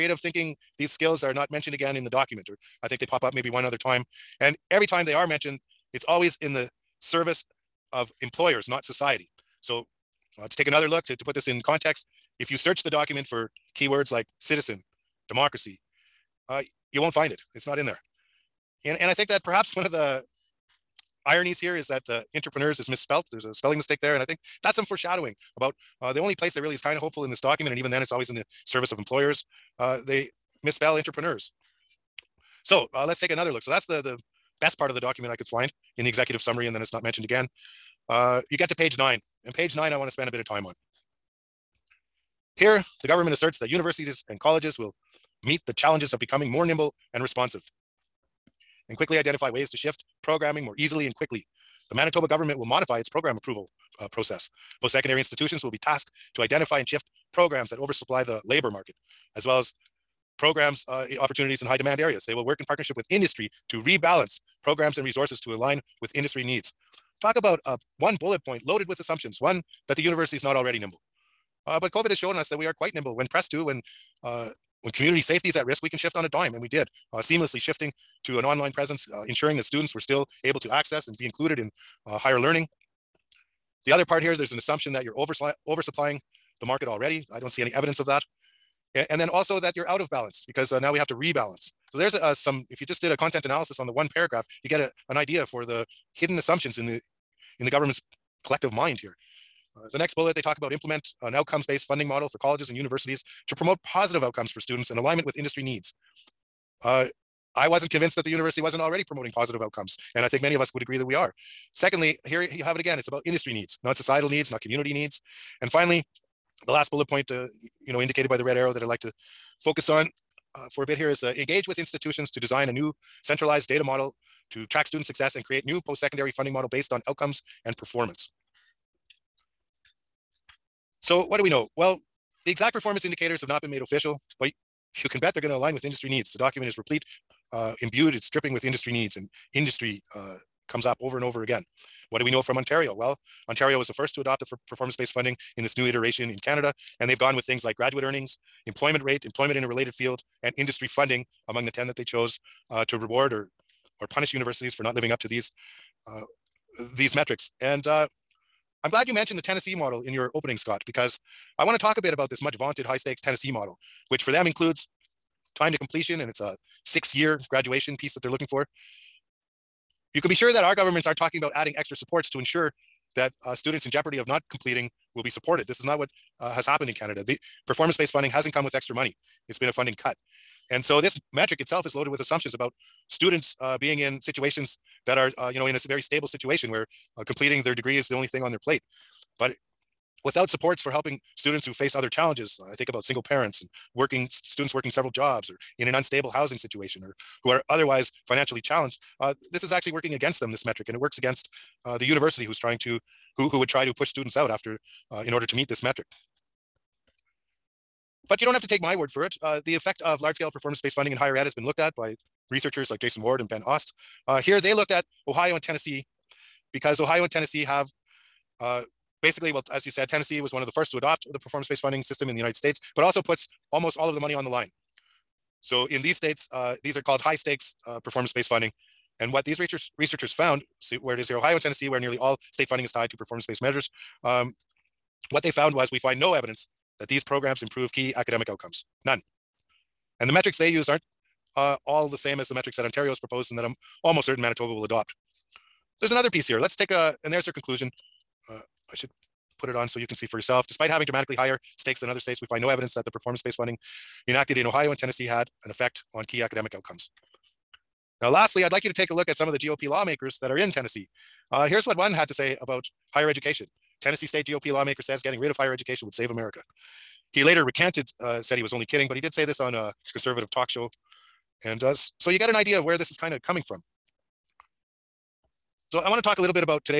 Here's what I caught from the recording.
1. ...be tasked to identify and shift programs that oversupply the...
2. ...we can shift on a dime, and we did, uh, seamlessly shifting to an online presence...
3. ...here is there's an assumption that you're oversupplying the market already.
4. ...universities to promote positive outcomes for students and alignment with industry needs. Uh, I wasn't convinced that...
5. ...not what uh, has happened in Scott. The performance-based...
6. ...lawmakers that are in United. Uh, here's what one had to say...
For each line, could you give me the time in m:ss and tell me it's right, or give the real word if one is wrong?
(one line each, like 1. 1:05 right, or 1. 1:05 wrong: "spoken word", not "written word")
1. 0:55 right
2. 1:15 right
3. 1:24 right
4. 1:42 right
5. 2:55 wrong: "Canada", not "Scott"
6. 4:19 wrong: "Tennessee", not "United".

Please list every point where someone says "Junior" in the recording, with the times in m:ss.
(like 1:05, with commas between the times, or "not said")
not said.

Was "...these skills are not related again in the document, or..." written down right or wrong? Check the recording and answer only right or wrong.
wrong.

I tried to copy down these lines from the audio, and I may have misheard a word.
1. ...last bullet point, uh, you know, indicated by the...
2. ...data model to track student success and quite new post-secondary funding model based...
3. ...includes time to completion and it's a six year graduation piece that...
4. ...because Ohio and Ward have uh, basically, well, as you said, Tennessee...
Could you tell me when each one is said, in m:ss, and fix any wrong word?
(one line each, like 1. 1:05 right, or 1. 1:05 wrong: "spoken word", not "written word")
1. 1:56 right
2. 2:03 wrong: "create", not "quite"
3. 2:44 right
4. 3:36 wrong: "Tennessee", not "Ward".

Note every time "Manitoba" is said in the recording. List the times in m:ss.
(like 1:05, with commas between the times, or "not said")
0:51, 4:04.